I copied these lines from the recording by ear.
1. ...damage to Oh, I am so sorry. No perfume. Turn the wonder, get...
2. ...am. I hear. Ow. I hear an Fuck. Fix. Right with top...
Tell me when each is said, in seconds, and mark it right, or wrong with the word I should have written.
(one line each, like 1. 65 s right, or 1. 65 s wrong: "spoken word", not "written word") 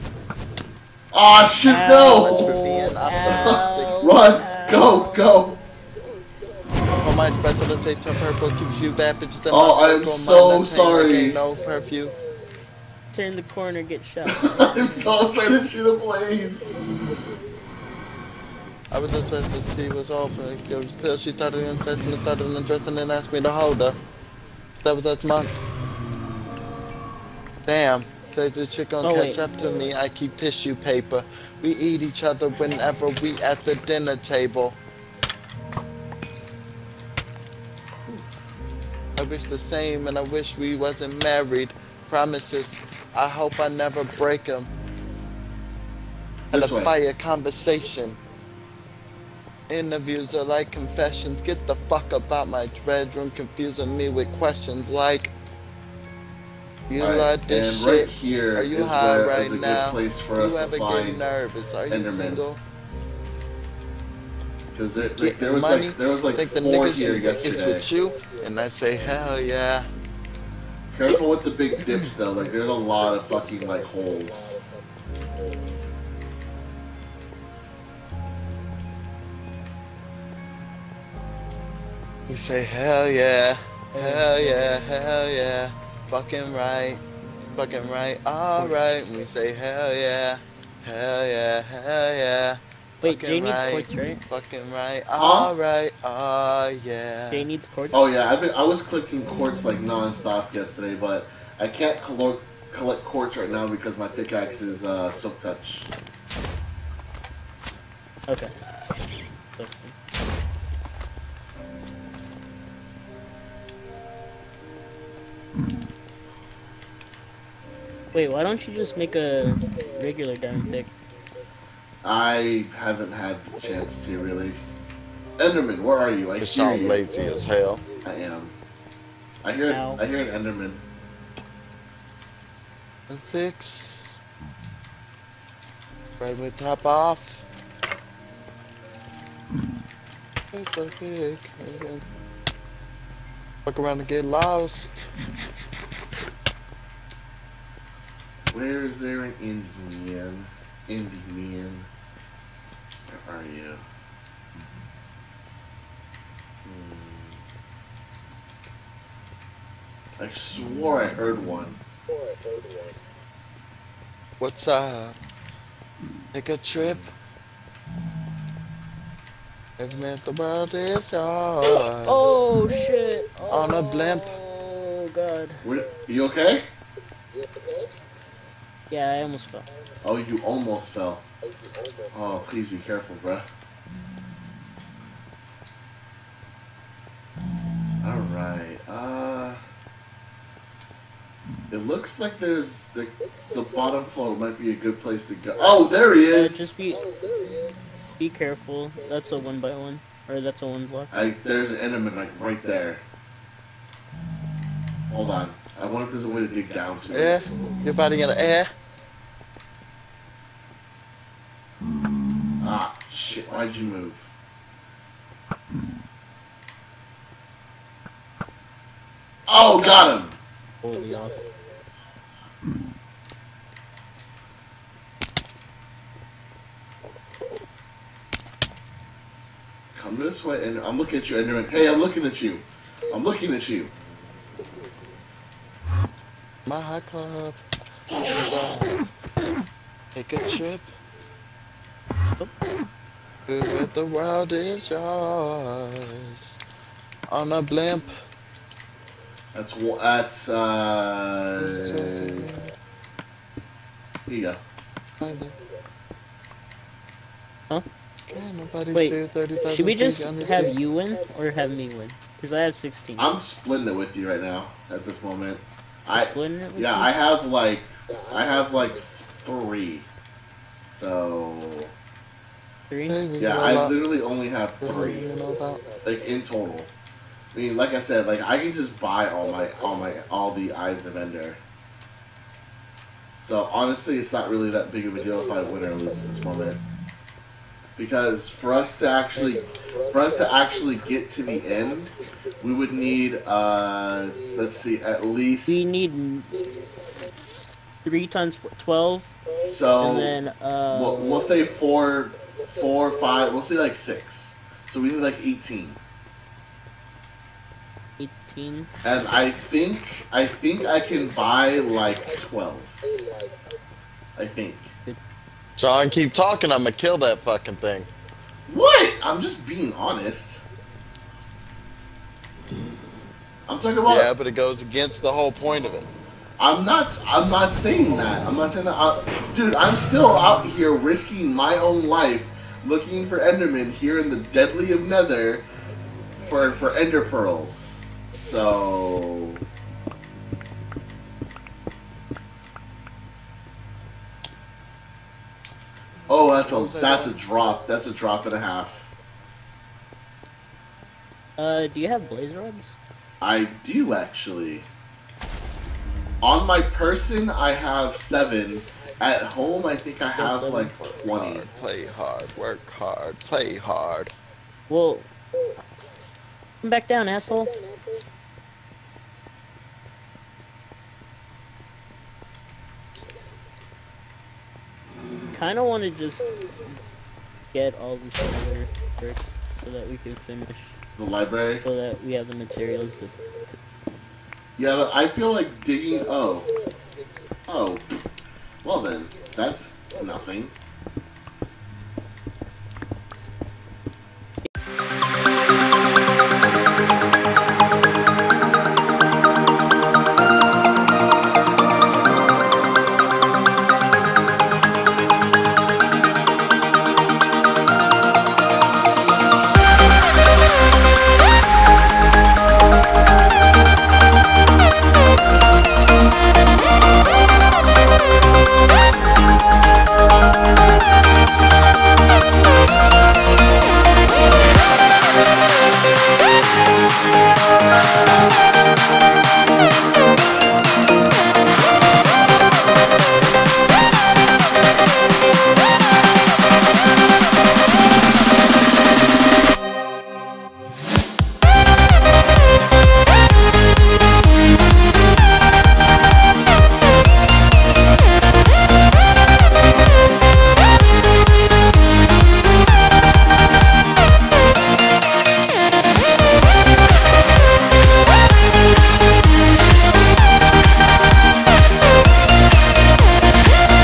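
1. 8 s wrong: "corner", not "wonder"
2. 128 s wrong: "Enderman", not "Fuck".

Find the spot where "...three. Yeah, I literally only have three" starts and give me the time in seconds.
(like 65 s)
272 s.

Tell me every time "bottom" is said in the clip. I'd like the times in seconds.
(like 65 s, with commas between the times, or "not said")
193 s.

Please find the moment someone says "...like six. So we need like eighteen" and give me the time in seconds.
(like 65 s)
303 s.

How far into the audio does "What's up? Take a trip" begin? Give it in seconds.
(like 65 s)
164 s.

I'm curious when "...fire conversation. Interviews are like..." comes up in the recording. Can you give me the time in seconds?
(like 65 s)
46 s.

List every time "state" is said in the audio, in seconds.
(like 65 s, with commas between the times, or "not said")
7 s.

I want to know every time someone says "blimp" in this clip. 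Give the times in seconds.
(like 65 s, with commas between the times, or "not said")
173 s, 247 s.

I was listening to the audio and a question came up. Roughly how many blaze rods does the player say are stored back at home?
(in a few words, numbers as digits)
20.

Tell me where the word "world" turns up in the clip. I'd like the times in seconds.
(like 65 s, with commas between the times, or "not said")
170 s, 244 s.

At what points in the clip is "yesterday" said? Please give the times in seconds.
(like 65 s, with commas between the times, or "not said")
67 s, 100 s.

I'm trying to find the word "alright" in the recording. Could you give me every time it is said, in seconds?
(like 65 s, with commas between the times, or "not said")
88 s, 95 s, 188 s.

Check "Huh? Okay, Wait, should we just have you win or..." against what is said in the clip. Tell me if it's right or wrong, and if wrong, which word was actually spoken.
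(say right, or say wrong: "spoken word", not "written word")
right.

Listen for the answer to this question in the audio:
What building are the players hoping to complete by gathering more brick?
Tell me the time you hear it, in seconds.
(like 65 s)
381 s.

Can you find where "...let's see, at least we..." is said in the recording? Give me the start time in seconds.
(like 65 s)
294 s.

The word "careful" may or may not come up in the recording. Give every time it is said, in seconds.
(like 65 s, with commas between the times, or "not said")
70 s, 182 s, 198 s.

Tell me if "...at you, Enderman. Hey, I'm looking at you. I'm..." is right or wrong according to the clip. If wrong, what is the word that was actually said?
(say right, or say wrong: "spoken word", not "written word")
right.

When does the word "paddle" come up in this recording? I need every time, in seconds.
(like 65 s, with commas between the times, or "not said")
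not said.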